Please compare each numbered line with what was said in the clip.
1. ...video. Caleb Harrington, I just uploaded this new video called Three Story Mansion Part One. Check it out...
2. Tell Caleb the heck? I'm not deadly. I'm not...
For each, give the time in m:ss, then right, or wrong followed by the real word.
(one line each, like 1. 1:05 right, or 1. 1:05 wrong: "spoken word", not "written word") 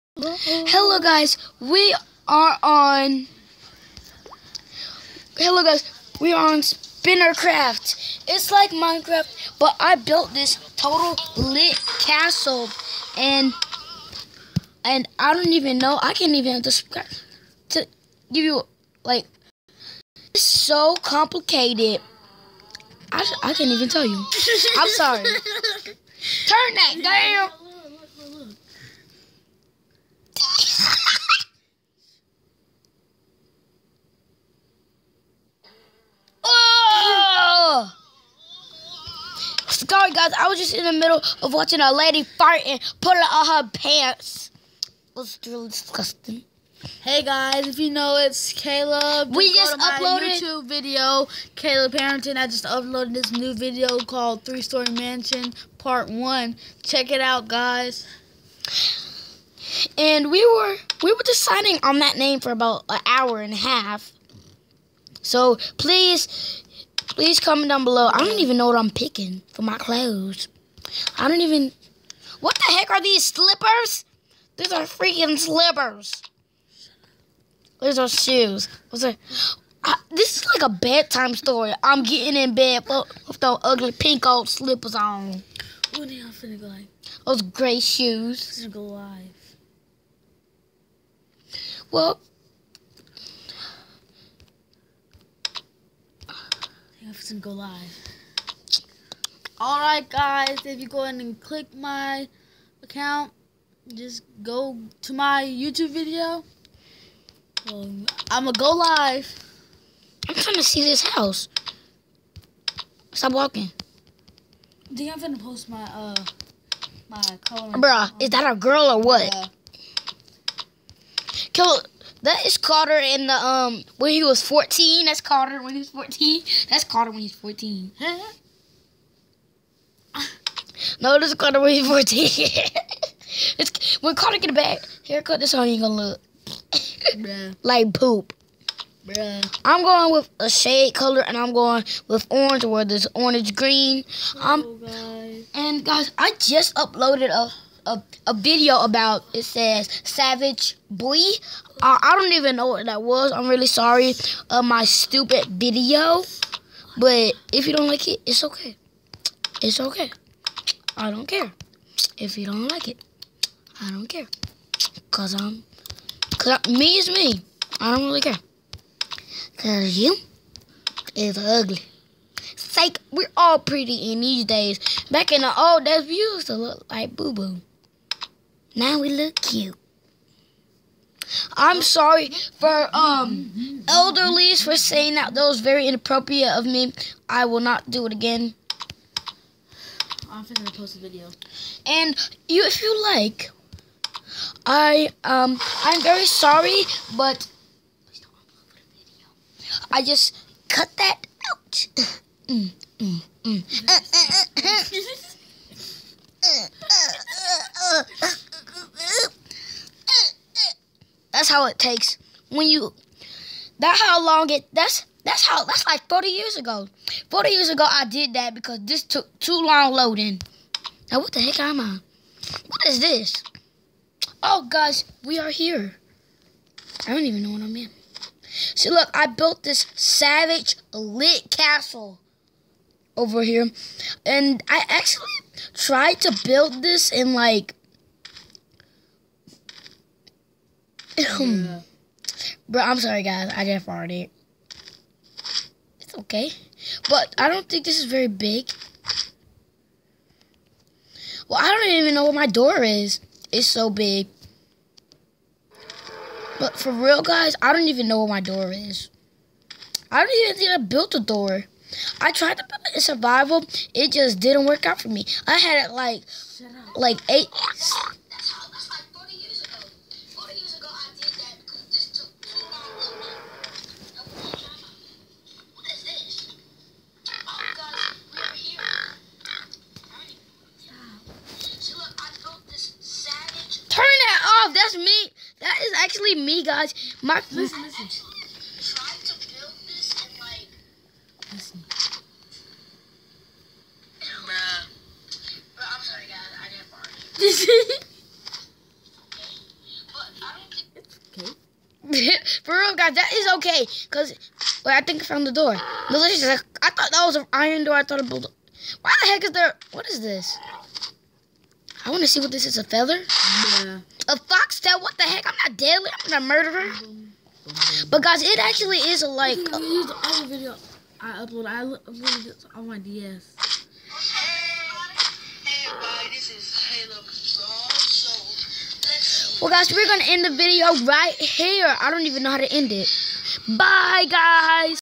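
1. 0:50 right
2. 5:14 wrong: "What", not "Caleb".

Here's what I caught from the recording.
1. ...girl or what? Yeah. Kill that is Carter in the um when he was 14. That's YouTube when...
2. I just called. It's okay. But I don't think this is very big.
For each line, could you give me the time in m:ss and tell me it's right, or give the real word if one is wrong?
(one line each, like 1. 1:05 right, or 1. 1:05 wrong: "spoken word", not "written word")
1. 1:58 wrong: "Carter", not "YouTube"
2. 4:03 wrong: "farted", not "called".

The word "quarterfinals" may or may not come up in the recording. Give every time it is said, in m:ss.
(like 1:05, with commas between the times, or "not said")
not said.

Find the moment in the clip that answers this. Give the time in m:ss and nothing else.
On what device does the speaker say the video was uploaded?
5:22.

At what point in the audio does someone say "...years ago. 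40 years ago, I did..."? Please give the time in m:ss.
3:36.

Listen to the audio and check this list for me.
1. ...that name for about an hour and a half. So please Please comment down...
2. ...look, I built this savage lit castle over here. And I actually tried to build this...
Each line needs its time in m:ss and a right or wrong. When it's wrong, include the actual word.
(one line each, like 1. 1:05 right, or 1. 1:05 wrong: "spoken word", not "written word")
1. 1:01 right
2. 3:48 right.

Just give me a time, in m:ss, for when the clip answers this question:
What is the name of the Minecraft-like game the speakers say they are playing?
0:06.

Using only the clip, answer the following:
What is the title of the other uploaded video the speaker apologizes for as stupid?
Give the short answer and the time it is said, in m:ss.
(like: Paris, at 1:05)
Savage Boy, at 2:30.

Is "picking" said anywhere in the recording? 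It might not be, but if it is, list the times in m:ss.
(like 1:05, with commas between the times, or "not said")
1:08.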